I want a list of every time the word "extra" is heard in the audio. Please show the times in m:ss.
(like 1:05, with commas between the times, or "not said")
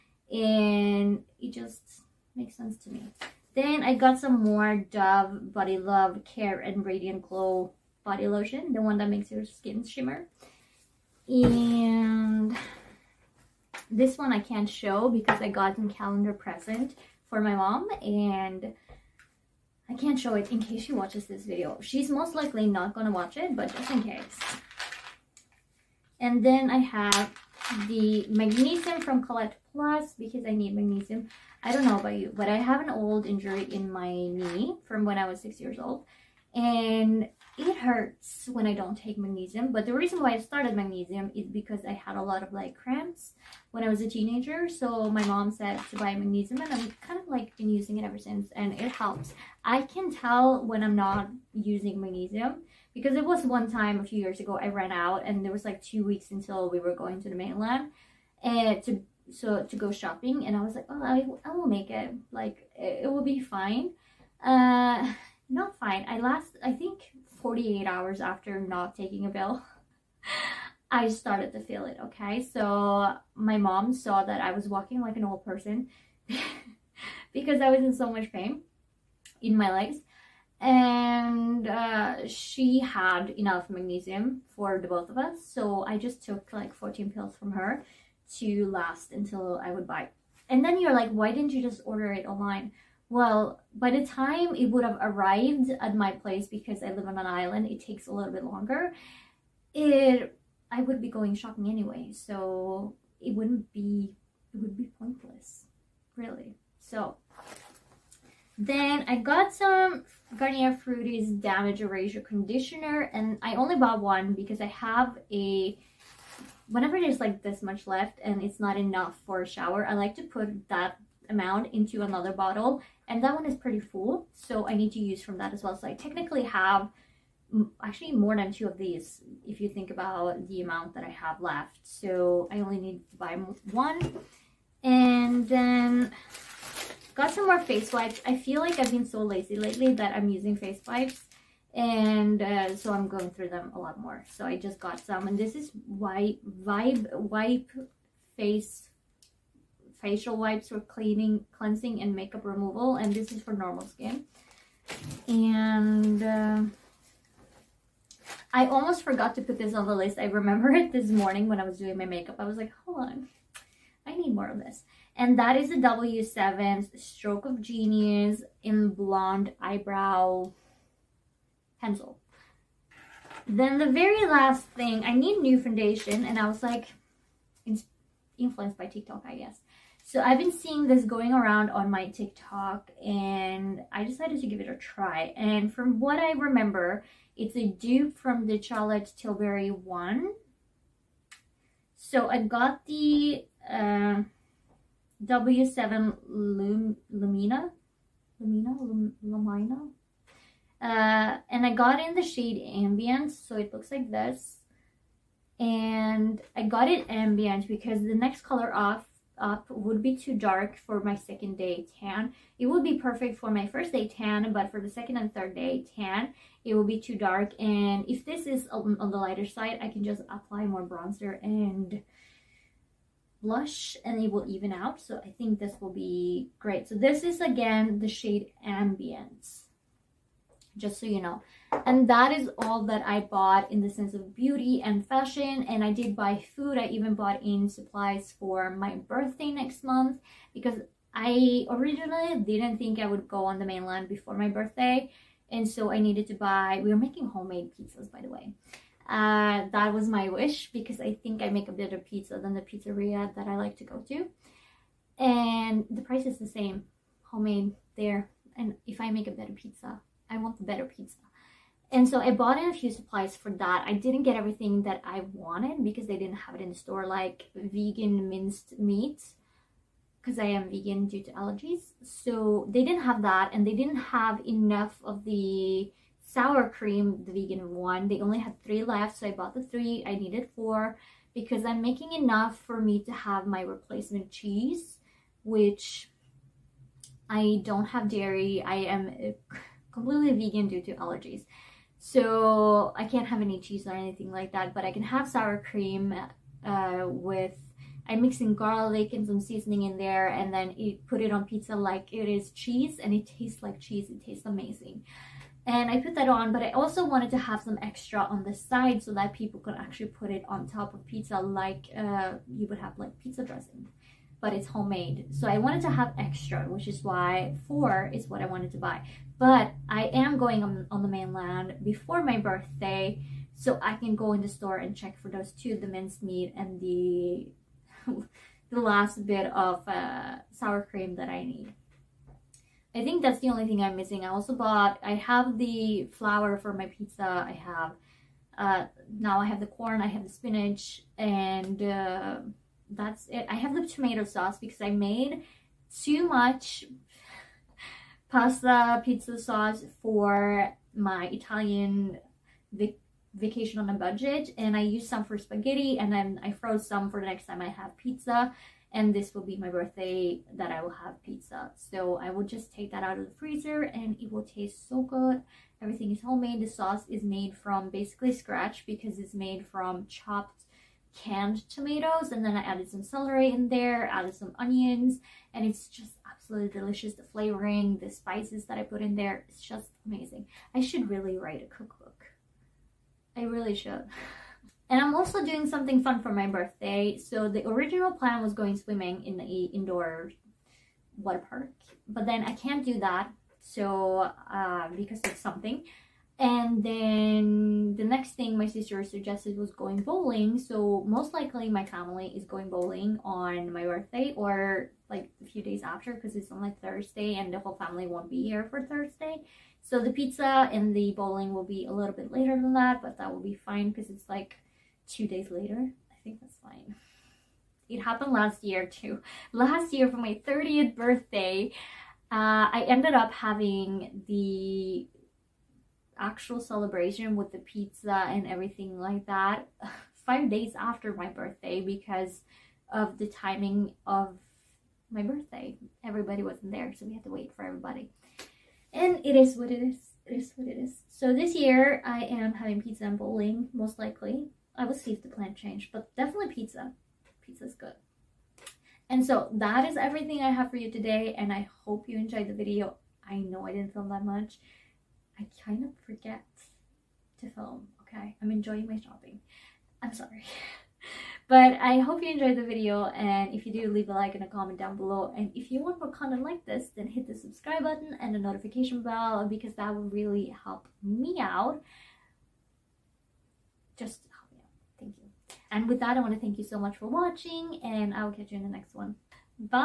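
5:07, 5:16.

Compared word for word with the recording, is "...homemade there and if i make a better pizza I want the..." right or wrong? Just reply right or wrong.
right.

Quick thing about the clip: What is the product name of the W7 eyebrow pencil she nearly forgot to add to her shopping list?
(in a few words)
Stroke of Genius.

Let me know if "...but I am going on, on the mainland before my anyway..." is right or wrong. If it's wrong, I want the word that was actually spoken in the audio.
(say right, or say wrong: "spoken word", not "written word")
wrong: "birthday", not "anyway".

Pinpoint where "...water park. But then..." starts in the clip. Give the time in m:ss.
6:31.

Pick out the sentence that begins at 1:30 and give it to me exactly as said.
And then you're like, why didn't you just order it online?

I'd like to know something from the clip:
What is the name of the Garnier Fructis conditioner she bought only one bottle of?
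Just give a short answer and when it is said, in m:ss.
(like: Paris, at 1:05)
Damage Eraser, at 1:51.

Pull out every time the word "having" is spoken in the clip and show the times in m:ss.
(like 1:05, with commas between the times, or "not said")
7:03, 7:22.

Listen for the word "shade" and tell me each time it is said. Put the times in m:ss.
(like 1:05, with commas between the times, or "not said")
3:22, 3:48.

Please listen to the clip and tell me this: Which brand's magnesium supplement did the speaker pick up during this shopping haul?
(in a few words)
Colette Plus.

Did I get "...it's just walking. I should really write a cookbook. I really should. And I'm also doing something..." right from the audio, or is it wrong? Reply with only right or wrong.
wrong.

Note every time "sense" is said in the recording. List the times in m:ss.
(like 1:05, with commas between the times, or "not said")
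0:02, 3:53.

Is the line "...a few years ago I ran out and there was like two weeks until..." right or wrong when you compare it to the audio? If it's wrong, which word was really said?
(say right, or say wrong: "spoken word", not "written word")
right.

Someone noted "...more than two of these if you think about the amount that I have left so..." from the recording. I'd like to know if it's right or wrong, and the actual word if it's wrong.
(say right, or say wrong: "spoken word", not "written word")
right.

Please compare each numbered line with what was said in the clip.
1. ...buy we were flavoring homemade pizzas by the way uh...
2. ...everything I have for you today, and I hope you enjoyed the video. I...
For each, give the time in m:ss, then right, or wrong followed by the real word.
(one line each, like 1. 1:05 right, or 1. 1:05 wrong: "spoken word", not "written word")
1. 4:06 wrong: "making", not "flavoring"
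2. 7:29 right.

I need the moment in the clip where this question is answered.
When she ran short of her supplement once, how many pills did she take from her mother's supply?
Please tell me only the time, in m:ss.
1:26.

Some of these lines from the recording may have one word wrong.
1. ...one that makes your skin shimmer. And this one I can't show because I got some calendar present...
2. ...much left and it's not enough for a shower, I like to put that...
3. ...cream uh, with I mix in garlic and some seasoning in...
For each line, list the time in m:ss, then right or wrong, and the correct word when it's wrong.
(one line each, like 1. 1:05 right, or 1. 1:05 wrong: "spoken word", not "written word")
1. 0:08 right
2. 1:57 right
3. 4:55 right.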